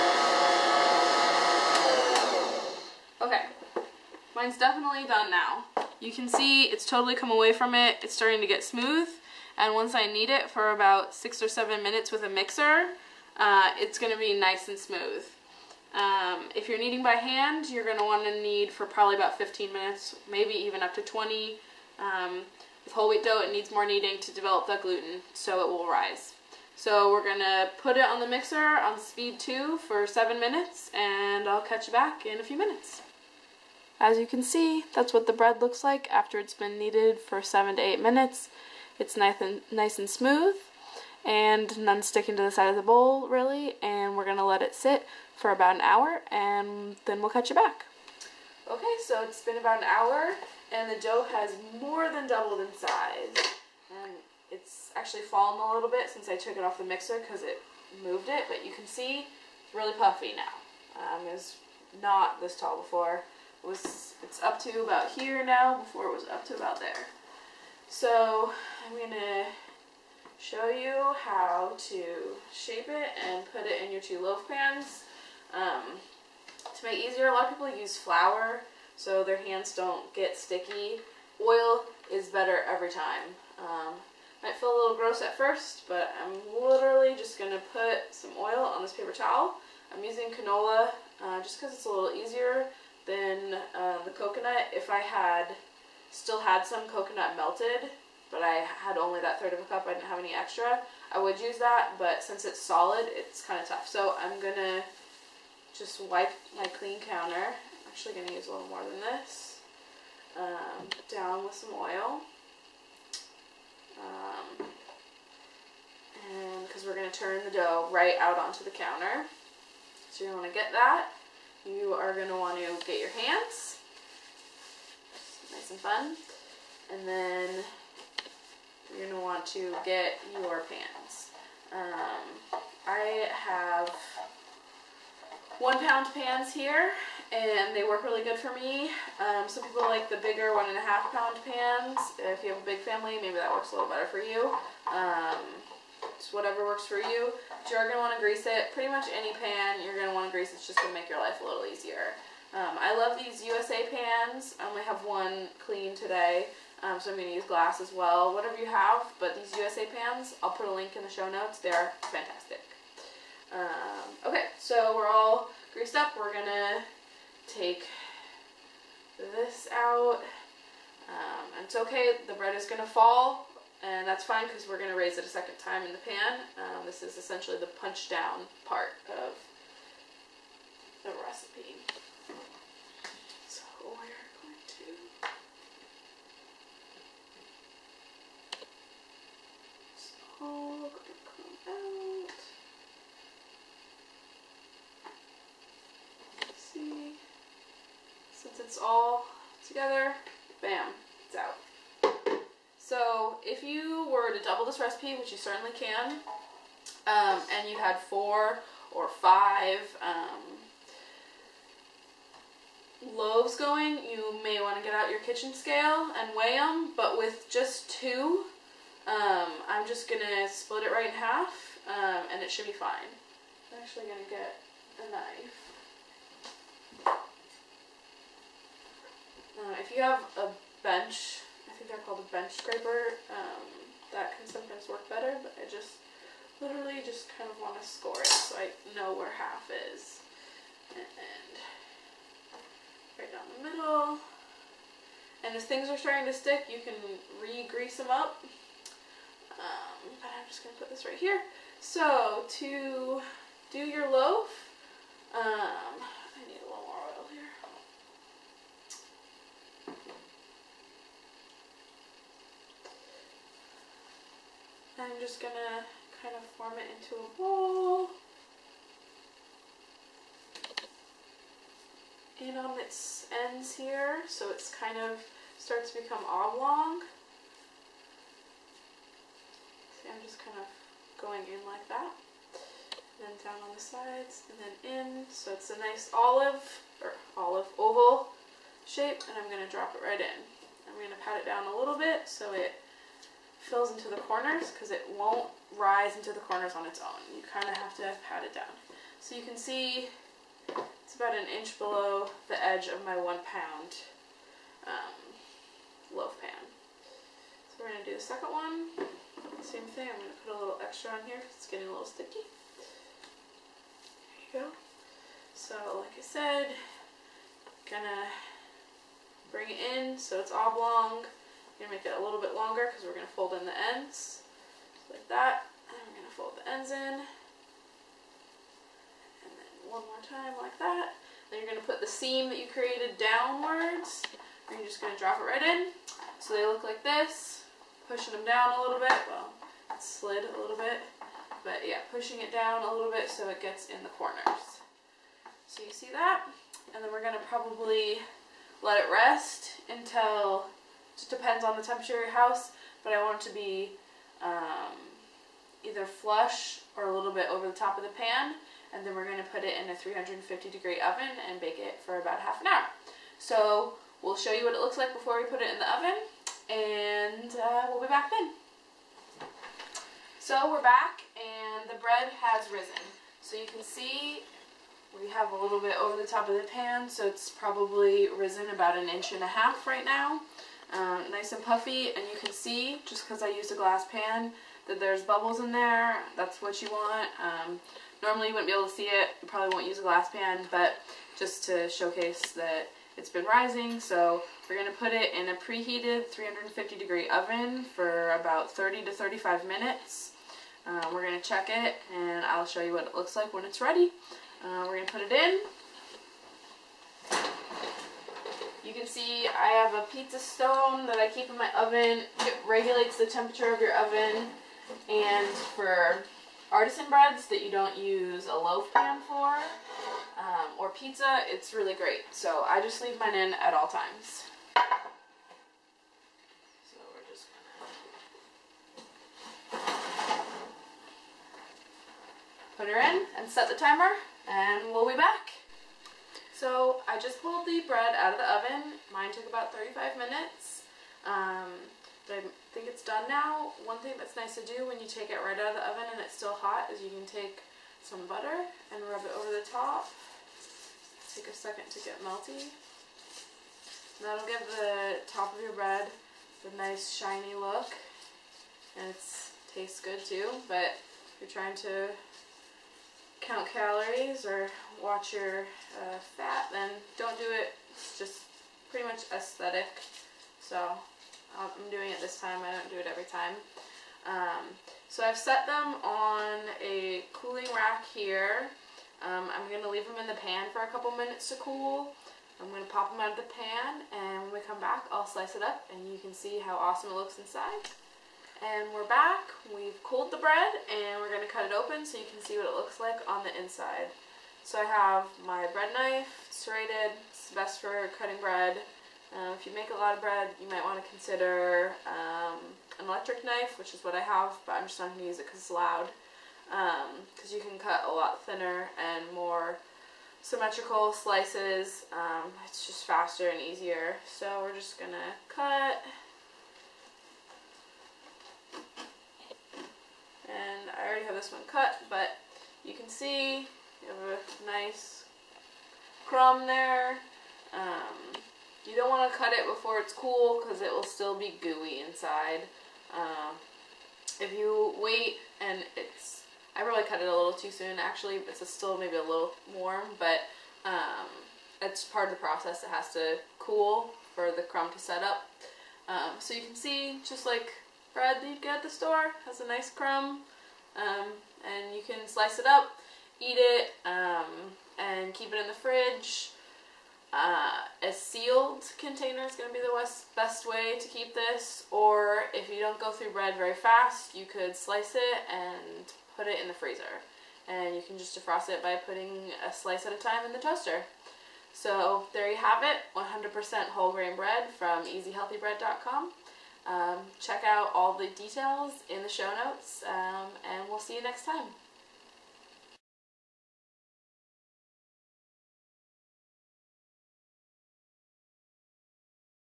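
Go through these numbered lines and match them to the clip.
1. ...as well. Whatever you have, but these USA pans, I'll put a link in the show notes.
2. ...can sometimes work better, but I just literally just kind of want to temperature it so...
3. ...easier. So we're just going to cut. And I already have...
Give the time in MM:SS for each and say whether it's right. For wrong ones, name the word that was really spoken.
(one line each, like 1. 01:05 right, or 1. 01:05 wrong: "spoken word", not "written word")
1. 02:37 right
2. 03:54 wrong: "score", not "temperature"
3. 08:33 right.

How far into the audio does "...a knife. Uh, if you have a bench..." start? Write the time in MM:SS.
03:44.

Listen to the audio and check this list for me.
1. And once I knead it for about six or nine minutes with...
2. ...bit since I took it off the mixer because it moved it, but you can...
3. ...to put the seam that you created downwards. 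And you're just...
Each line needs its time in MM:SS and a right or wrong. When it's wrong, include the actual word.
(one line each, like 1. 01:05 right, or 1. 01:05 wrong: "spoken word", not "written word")
1. 00:09 wrong: "seven", not "nine"
2. 00:55 right
3. 05:31 right.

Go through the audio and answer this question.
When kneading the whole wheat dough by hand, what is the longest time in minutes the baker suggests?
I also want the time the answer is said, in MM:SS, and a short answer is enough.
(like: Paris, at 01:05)
20, at 00:20.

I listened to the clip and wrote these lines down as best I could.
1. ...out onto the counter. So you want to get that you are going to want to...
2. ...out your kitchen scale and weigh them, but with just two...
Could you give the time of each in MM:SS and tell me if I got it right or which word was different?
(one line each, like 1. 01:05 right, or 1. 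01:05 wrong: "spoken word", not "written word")
1. 01:58 right
2. 03:34 right.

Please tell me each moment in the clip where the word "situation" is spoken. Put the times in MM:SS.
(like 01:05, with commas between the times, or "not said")
not said.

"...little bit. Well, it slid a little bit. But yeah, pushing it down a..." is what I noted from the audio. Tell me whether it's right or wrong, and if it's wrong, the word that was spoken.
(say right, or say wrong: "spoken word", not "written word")
right.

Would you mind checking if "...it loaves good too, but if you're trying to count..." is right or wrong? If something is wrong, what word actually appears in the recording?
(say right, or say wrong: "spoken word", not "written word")
wrong: "tastes", not "loaves".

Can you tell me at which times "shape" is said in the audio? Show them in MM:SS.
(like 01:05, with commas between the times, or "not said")
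01:12, 04:48.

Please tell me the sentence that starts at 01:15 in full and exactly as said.
Um, to make it easier, a lot of people use flour so their hands don't get sticky.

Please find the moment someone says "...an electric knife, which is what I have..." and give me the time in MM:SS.
08:22.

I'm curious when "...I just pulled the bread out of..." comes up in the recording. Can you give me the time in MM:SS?
07:17.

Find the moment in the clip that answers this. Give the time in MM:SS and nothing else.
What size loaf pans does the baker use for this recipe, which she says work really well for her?
02:15.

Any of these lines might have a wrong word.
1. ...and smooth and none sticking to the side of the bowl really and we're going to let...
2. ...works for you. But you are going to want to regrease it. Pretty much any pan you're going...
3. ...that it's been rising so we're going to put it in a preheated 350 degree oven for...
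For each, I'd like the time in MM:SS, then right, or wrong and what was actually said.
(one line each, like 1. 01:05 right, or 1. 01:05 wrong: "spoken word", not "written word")
1. 00:39 right
2. 02:26 wrong: "grease", not "regrease"
3. 06:32 right.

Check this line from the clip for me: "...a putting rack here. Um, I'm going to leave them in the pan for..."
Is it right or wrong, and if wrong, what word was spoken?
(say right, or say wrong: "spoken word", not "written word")
wrong: "cooling", not "putting".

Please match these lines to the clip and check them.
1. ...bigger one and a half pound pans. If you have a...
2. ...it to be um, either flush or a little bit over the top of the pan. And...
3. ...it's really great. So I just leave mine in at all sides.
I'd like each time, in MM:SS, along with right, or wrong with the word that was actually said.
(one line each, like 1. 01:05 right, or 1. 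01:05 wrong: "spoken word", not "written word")
1. 02:20 right
2. 05:53 right
3. 07:01 wrong: "times", not "sides".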